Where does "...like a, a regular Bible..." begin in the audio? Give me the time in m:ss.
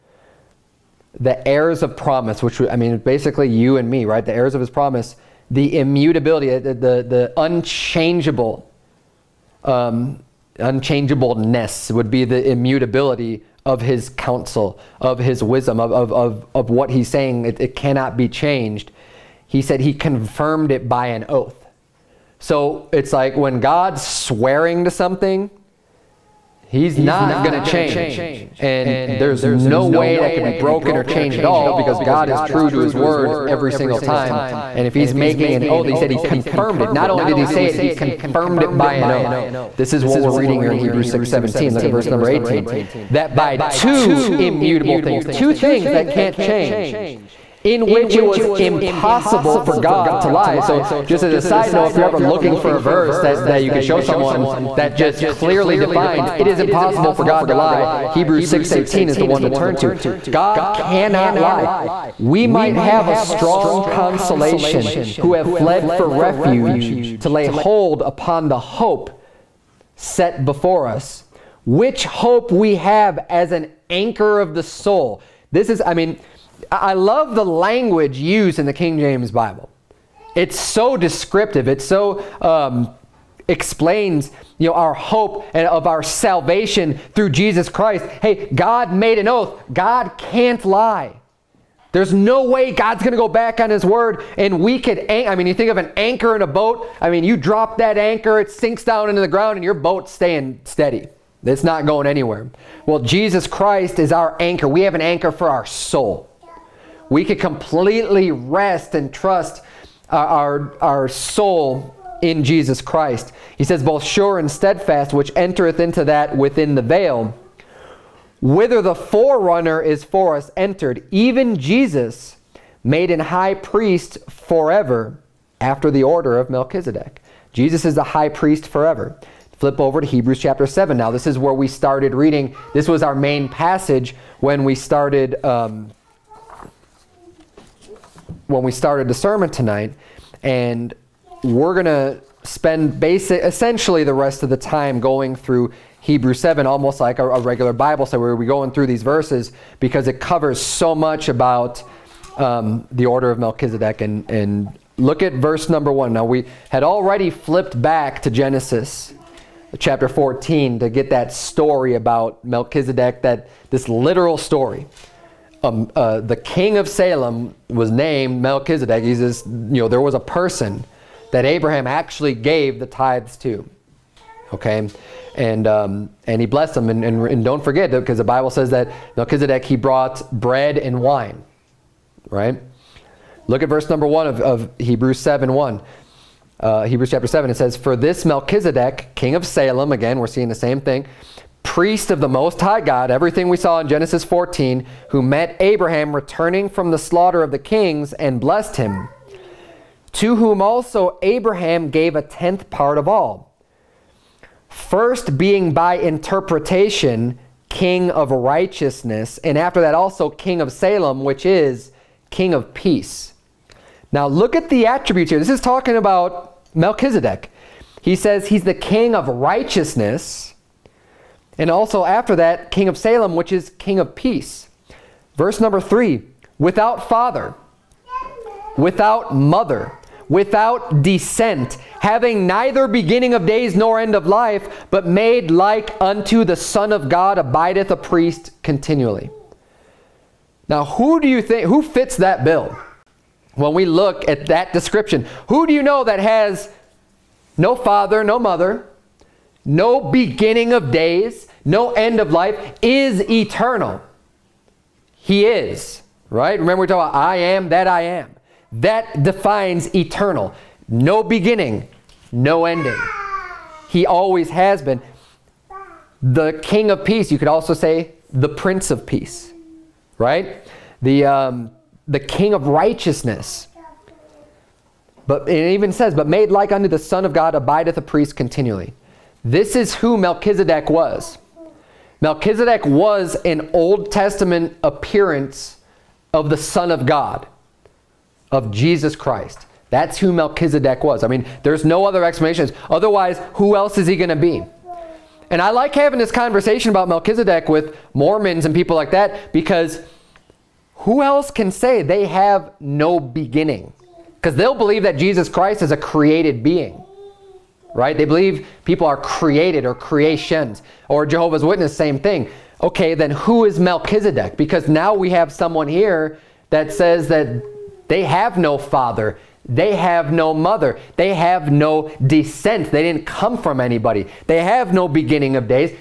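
2:26.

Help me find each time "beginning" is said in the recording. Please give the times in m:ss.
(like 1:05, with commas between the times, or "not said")
3:52, 4:10, 4:21, 5:03, 5:25.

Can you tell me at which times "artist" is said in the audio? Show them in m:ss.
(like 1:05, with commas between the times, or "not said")
not said.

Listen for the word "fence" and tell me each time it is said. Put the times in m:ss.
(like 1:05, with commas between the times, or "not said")
not said.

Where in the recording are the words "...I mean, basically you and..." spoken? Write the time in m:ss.
0:02.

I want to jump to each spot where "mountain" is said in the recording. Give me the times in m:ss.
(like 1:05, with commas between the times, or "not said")
not said.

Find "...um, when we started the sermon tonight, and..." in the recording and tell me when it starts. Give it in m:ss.
2:15.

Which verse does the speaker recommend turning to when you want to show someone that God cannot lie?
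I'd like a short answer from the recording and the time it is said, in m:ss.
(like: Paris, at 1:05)
Hebrews 6:18, at 0:58.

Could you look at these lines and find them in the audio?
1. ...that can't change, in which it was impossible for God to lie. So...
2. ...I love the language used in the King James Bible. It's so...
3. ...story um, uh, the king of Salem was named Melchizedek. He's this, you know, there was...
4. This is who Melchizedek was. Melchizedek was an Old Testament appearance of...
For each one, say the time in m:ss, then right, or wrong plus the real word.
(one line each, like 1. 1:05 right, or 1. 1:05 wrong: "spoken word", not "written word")
1. 0:45 right
2. 1:16 right
3. 2:44 right
4. 4:39 right.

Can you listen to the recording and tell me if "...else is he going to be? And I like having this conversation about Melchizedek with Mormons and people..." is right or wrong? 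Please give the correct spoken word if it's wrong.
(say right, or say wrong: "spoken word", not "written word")
right.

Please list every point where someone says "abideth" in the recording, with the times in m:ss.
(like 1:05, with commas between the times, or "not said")
3:57, 4:37.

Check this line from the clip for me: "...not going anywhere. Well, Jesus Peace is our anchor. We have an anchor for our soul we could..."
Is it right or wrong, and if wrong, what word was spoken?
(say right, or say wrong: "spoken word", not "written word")
wrong: "Christ", not "Peace".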